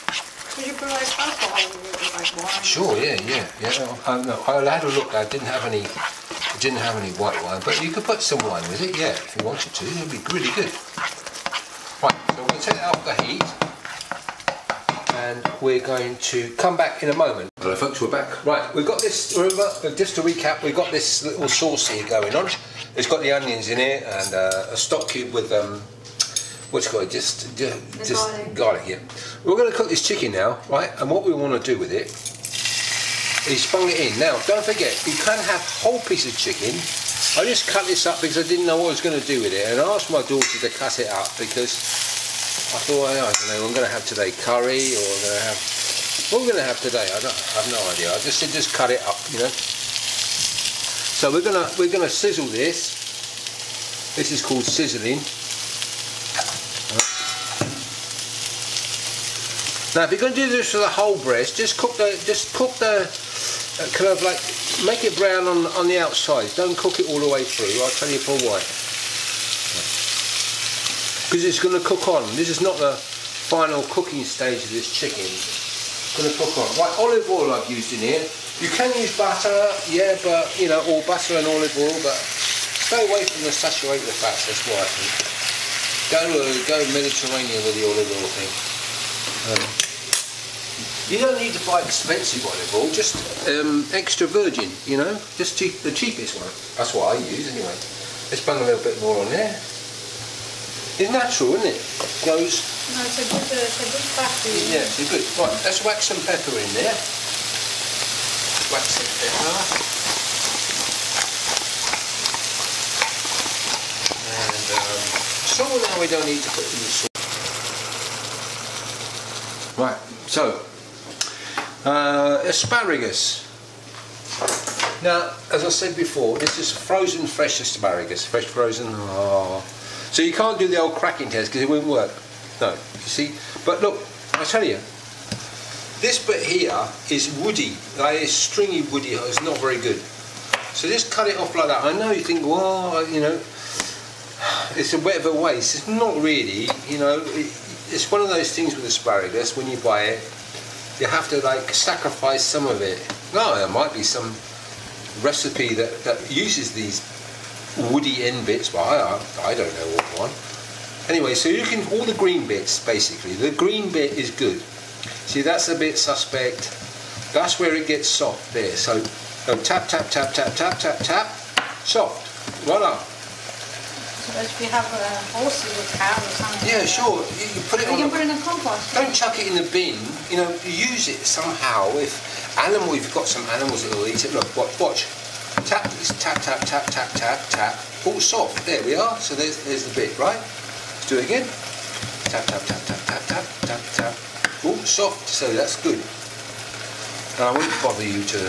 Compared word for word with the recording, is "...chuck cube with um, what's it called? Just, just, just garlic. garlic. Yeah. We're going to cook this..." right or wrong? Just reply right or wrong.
wrong.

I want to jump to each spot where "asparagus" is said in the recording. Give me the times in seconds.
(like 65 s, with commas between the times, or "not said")
122 s, 127 s, 148 s.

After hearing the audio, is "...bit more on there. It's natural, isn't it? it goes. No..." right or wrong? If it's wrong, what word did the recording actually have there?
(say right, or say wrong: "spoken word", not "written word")
right.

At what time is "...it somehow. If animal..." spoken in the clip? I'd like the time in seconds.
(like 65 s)
181 s.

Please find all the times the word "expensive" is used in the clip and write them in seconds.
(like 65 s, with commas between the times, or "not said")
91 s.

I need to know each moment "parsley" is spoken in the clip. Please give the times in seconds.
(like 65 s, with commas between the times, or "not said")
not said.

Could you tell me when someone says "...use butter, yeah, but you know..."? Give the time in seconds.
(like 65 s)
78 s.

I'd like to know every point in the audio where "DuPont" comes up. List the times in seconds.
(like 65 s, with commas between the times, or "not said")
not said.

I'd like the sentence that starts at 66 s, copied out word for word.
Don't cook it all the way through.